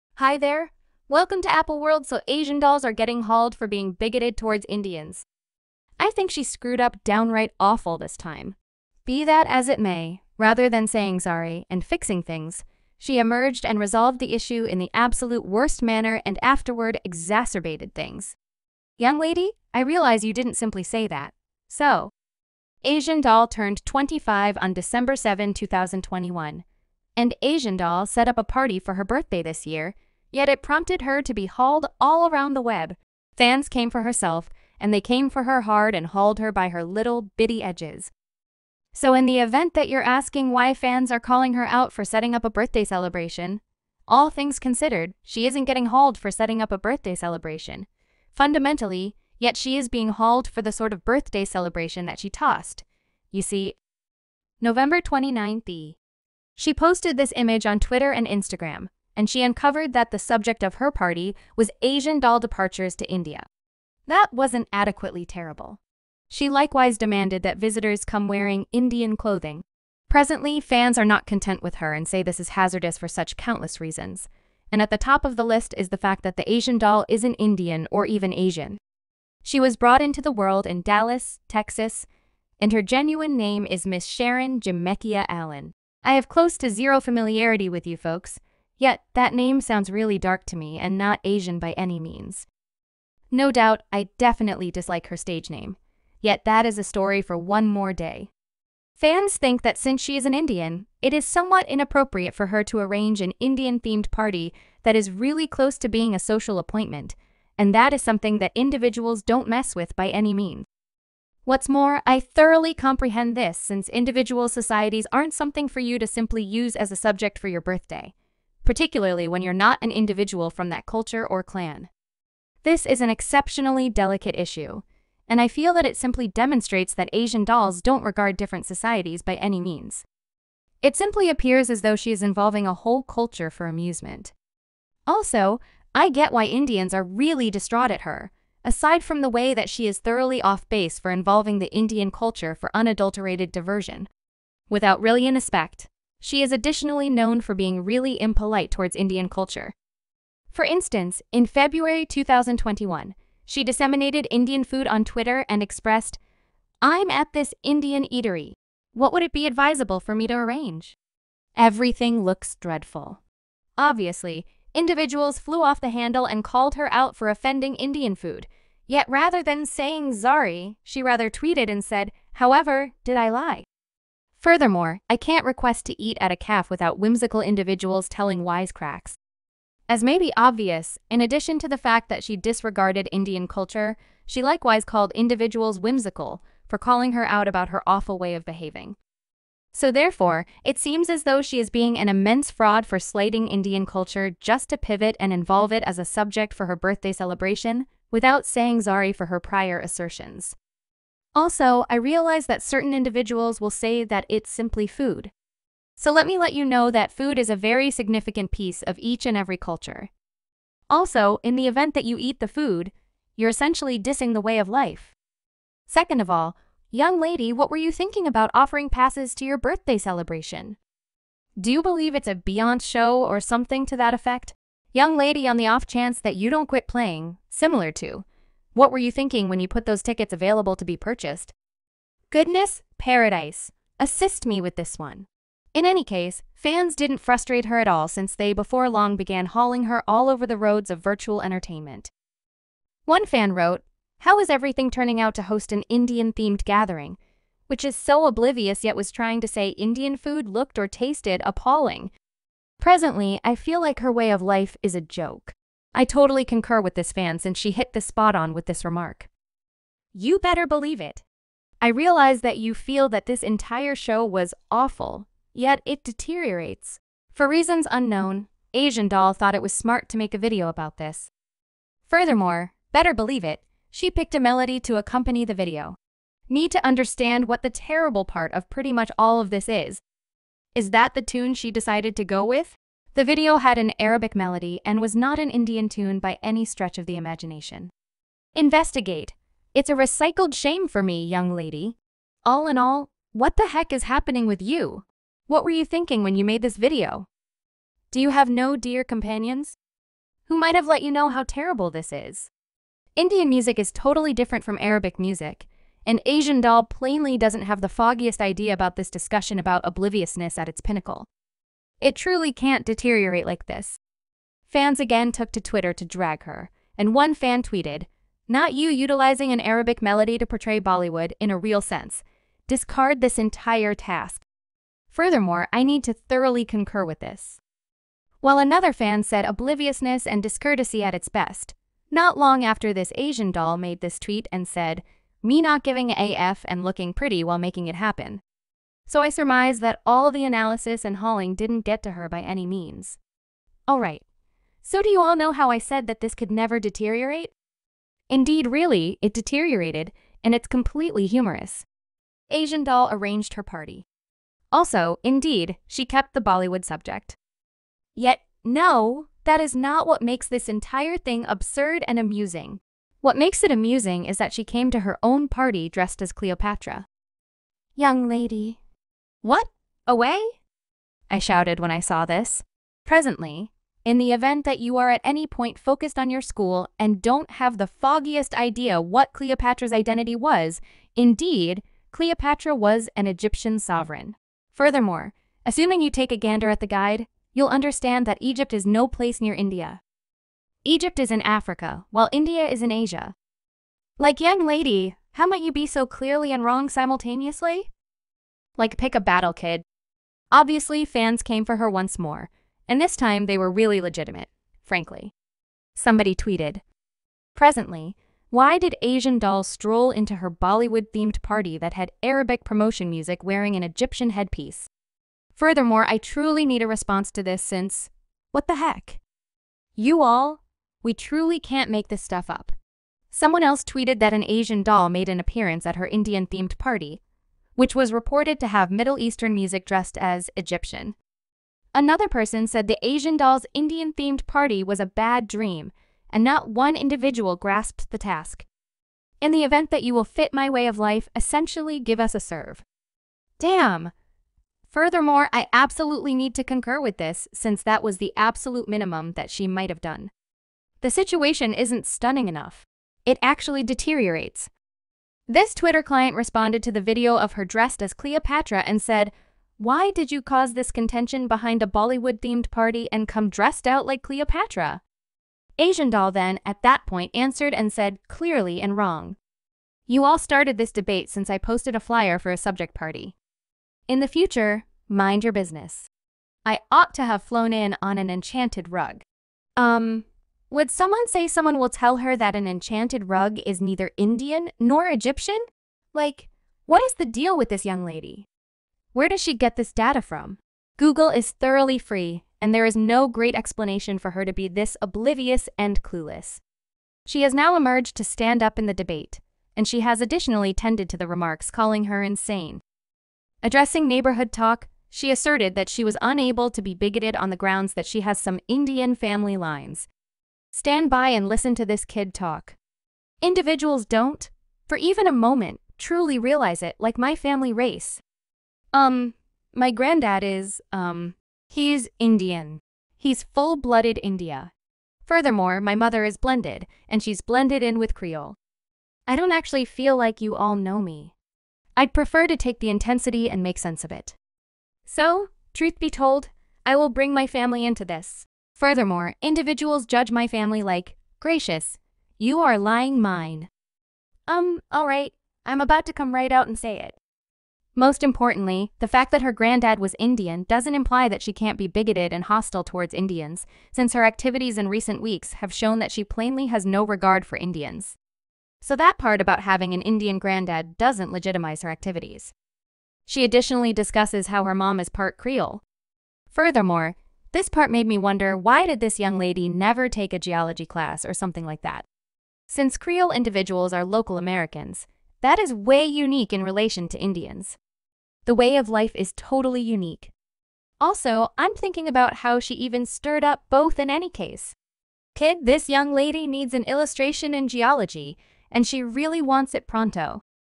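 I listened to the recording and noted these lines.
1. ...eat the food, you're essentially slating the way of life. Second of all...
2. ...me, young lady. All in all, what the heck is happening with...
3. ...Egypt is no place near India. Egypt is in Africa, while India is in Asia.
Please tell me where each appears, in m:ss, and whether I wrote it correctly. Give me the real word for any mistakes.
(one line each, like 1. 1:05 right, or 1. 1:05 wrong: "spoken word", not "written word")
1. 3:32 wrong: "dissing", not "slating"
2. 4:51 right
3. 6:28 right.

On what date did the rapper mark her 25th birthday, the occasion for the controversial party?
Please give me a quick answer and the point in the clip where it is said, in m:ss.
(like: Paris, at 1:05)
December 7, 2021, at 0:24.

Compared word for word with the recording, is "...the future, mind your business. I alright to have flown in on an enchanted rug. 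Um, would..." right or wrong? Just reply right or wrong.
wrong.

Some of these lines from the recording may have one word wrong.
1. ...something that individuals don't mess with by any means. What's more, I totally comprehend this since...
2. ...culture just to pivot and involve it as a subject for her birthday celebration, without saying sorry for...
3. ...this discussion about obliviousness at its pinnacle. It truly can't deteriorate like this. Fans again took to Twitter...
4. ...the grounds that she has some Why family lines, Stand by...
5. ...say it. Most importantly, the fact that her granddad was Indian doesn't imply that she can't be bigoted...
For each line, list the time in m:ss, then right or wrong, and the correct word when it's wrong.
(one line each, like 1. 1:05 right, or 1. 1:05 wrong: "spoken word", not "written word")
1. 1:48 wrong: "thoroughly", not "totally"
2. 3:13 right
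3. 5:08 right
4. 8:27 wrong: "Indian", not "Why"
5. 9:06 right.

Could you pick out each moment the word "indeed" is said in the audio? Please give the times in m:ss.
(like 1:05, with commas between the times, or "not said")
5:48, 5:55, 6:21.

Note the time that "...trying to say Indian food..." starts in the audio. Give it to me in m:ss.
4:09.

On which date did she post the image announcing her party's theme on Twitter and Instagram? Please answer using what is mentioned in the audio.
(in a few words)
November 29th.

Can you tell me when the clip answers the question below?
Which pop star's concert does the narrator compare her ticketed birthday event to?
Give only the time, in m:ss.
3:42.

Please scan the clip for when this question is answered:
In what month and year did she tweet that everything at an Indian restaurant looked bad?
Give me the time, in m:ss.
2:31.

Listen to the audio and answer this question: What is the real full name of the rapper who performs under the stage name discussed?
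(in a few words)
Sharon Jameckia Allen.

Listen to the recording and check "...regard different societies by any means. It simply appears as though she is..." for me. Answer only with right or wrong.
right.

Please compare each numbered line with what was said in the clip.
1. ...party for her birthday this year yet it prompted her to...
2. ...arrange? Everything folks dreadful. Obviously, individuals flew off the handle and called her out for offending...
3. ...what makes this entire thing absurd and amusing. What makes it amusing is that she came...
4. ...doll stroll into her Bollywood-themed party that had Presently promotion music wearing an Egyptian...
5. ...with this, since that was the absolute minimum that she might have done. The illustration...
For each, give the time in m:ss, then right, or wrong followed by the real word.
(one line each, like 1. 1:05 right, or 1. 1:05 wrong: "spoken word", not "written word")
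1. 0:28 right
2. 2:40 wrong: "looks", not "folks"
3. 6:00 right
4. 6:49 wrong: "Arabic", not "Presently"
5. 7:27 wrong: "situation", not "illustration".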